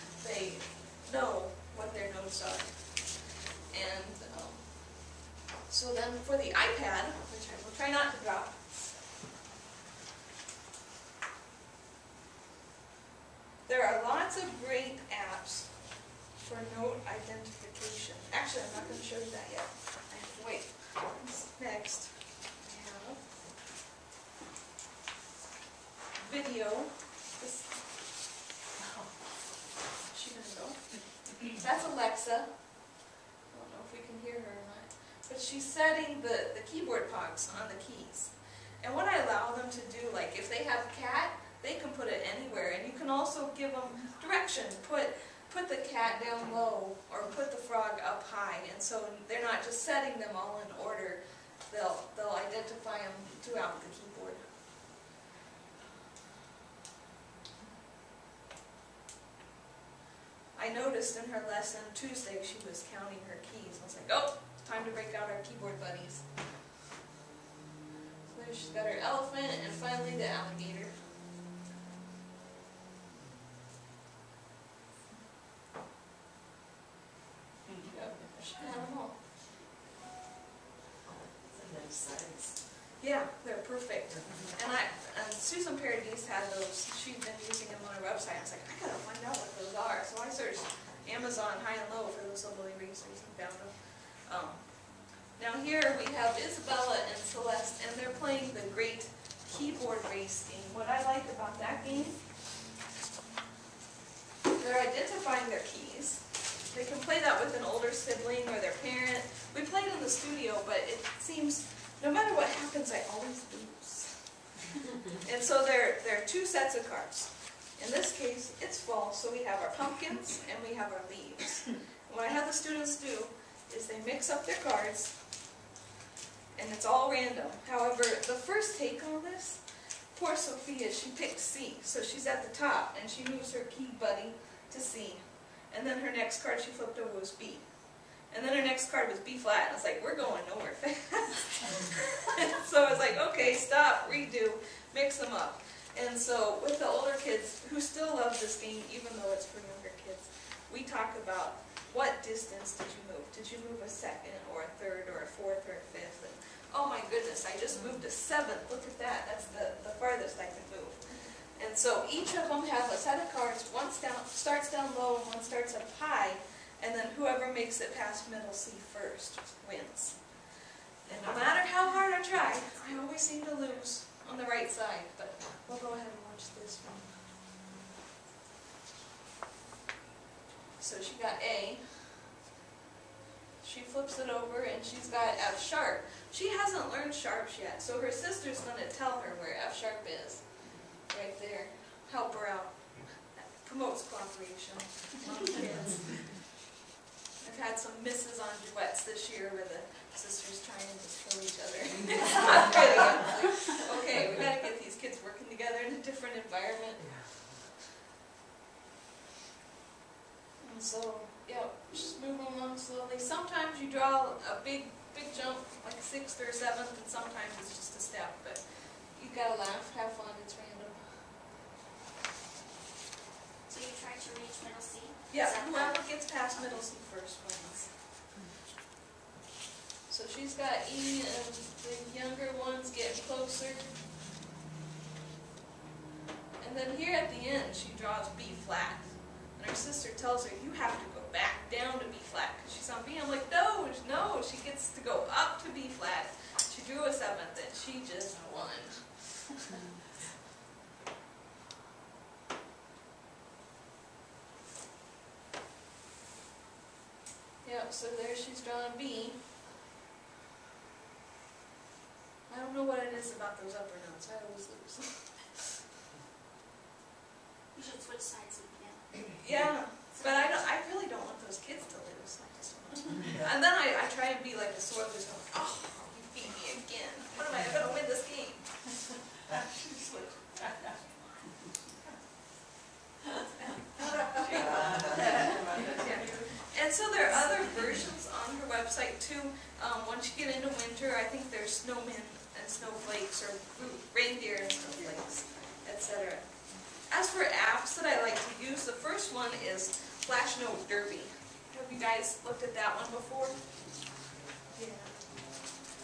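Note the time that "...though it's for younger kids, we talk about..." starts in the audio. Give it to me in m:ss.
2:29.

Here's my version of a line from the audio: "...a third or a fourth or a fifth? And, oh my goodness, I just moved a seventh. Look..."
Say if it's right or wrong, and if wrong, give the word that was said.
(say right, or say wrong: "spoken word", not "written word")
right.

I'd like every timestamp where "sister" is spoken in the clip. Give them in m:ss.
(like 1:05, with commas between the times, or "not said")
3:08, 3:20, 3:59.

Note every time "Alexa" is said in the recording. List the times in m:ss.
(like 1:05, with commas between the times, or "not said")
0:31.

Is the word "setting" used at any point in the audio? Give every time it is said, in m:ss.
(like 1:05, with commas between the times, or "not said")
0:35, 0:49.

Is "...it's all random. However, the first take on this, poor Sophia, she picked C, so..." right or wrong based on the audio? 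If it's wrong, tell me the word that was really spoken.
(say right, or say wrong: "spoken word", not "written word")
right.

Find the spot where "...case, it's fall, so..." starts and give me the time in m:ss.
1:58.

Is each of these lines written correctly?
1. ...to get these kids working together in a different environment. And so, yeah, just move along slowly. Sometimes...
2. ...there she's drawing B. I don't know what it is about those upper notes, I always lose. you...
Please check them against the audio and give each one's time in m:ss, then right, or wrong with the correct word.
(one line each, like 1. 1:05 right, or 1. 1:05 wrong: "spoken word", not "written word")
1. 3:24 right
2. 4:18 right.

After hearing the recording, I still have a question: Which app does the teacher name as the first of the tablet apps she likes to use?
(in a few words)
Flash Note Derby.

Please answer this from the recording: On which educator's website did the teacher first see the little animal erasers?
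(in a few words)
Susan Paradis.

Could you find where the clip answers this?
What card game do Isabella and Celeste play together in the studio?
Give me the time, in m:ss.
1:38.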